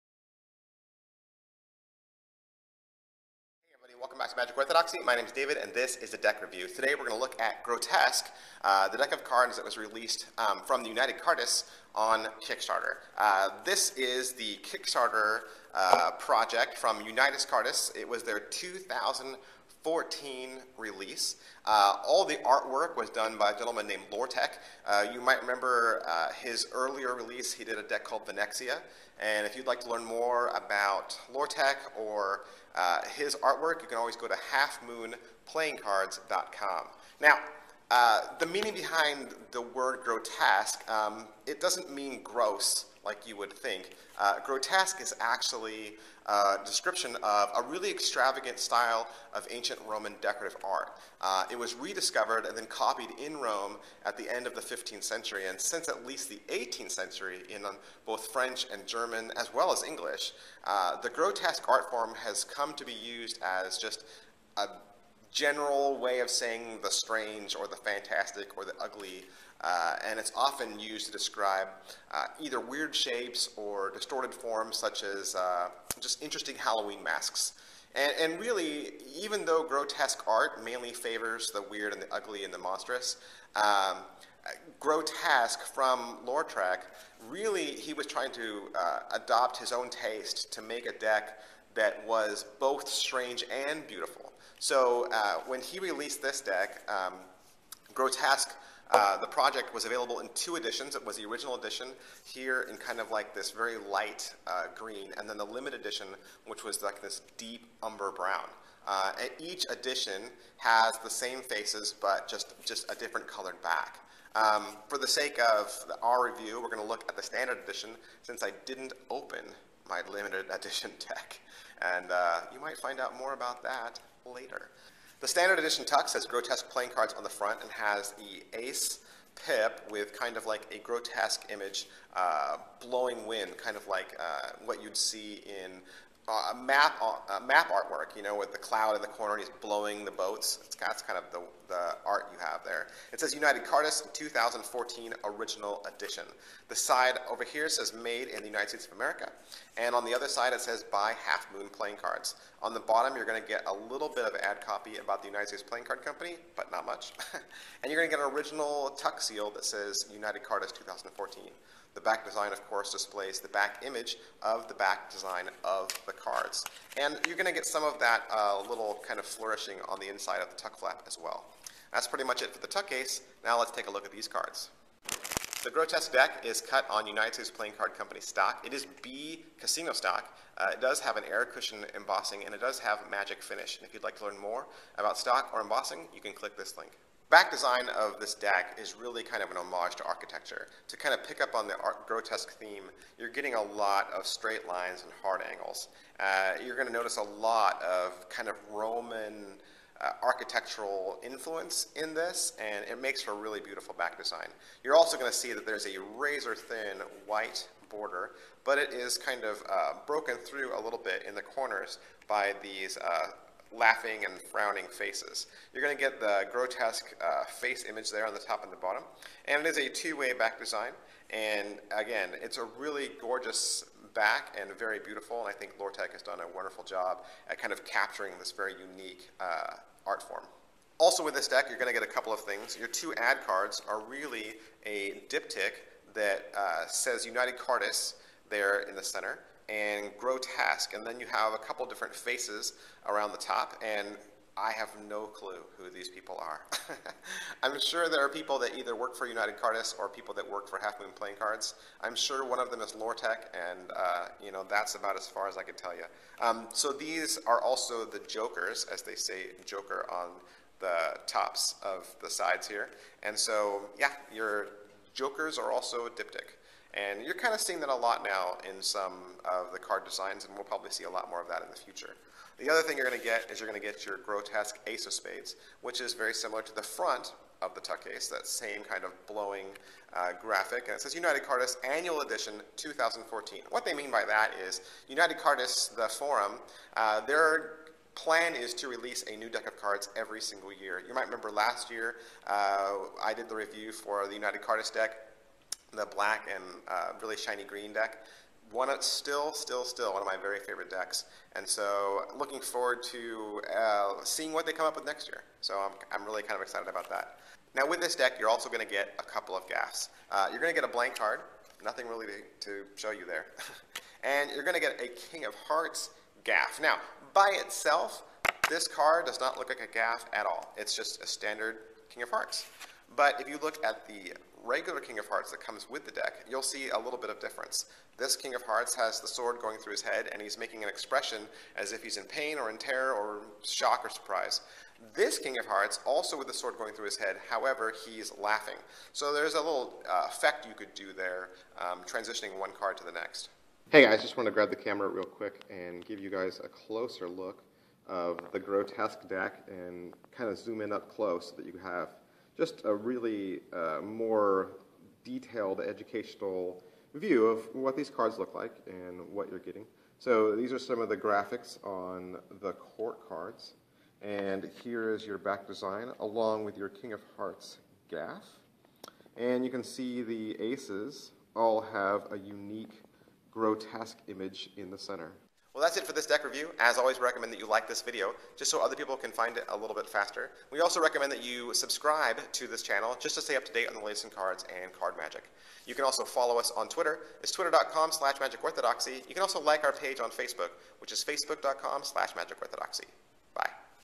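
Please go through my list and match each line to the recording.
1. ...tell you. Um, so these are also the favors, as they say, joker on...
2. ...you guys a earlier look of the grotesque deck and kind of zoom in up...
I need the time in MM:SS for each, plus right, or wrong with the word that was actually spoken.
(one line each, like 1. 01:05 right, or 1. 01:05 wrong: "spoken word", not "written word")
1. 04:15 wrong: "jokers", not "favors"
2. 05:46 wrong: "closer", not "earlier".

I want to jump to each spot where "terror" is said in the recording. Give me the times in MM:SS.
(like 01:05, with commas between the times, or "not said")
05:32.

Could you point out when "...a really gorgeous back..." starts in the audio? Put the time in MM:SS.
03:42.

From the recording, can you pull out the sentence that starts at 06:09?
And you can see the aces all have a unique grotesque image in the center.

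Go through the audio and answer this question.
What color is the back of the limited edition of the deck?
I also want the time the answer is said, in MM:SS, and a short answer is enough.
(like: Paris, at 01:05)
deep umber brown, at 01:47.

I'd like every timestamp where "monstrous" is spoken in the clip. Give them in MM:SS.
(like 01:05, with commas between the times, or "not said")
01:22.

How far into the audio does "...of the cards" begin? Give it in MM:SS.
02:45.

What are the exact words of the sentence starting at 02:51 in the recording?
That's pretty much it for the tuck case.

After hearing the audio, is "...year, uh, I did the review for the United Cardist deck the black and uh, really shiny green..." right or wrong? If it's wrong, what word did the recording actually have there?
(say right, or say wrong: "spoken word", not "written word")
right.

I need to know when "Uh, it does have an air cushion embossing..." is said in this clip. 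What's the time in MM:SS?
03:00.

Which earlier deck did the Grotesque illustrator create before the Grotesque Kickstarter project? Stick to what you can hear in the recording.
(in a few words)
Venexia.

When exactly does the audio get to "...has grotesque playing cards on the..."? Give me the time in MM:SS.
02:06.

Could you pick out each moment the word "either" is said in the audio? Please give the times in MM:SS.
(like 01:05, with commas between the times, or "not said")
01:12, 04:08.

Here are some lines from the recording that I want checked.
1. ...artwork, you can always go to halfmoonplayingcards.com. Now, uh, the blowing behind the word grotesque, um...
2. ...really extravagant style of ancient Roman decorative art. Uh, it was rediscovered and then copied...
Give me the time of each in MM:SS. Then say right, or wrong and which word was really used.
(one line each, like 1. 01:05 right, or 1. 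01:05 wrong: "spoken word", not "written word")
1. 00:33 wrong: "meaning", not "blowing"
2. 00:47 right.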